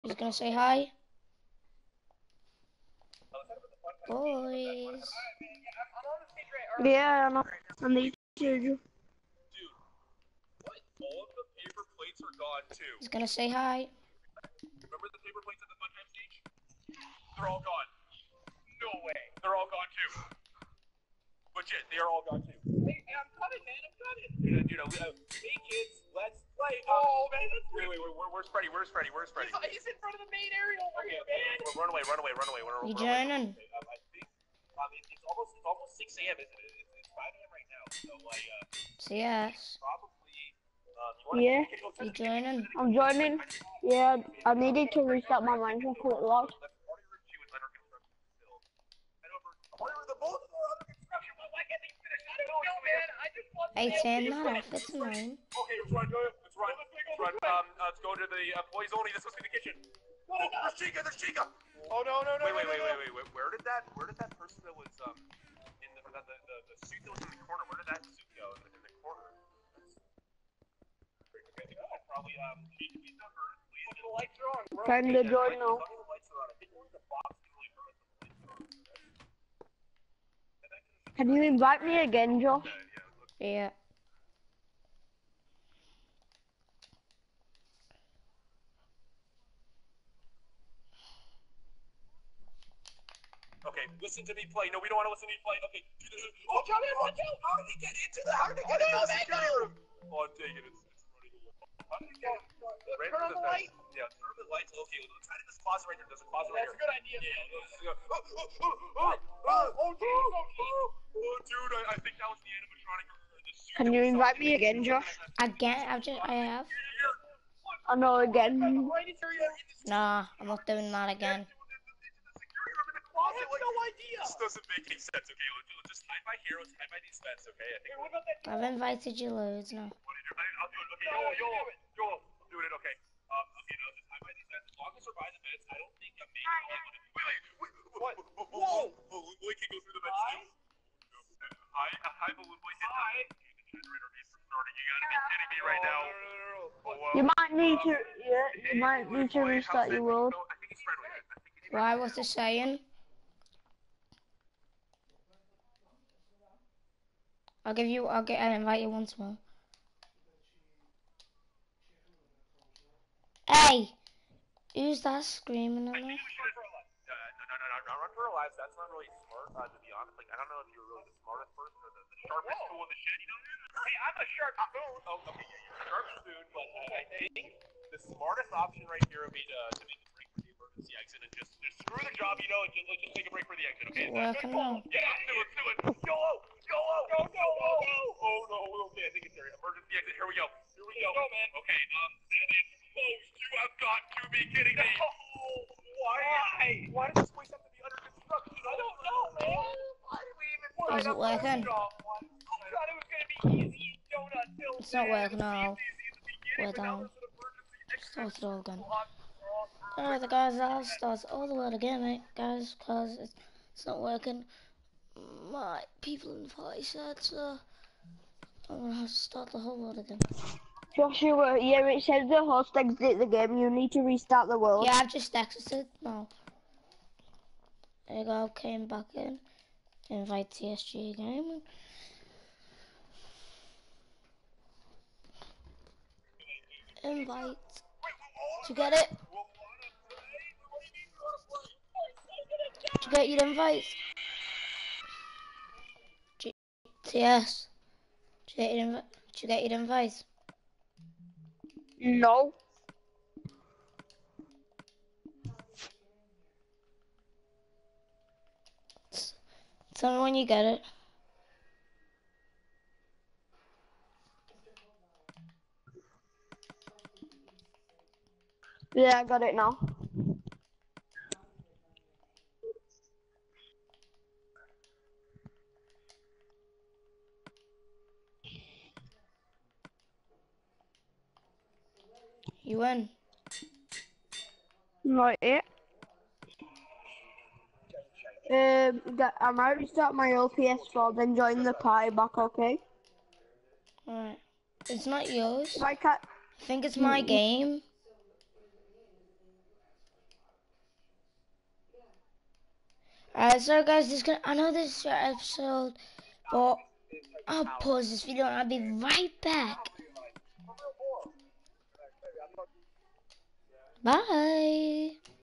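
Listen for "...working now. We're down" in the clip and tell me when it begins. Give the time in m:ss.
3:25.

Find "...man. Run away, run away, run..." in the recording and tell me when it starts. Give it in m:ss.
0:31.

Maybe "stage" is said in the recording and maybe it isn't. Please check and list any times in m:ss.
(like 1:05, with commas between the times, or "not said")
0:16.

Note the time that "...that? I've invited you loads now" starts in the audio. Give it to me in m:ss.
2:08.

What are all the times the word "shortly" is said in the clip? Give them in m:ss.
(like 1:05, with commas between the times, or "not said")
not said.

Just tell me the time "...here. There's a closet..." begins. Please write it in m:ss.
1:45.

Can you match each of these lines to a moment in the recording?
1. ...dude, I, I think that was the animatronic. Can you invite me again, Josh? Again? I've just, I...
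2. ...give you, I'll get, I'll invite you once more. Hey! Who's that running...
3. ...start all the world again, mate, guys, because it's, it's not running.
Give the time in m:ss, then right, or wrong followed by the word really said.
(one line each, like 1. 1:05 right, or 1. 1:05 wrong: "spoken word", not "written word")
1. 1:51 right
2. 2:37 wrong: "screaming", not "running"
3. 3:30 wrong: "working", not "running".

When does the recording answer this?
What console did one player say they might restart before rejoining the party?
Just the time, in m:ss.
4:50.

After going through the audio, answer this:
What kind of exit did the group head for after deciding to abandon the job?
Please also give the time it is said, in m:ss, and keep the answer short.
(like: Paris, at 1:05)
Emergency exit, at 3:09.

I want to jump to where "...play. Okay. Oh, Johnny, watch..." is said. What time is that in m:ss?
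1:35.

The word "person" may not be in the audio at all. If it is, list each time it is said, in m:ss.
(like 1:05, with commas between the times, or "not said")
1:04, 2:51.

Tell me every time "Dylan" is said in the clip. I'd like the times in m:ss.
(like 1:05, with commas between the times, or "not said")
not said.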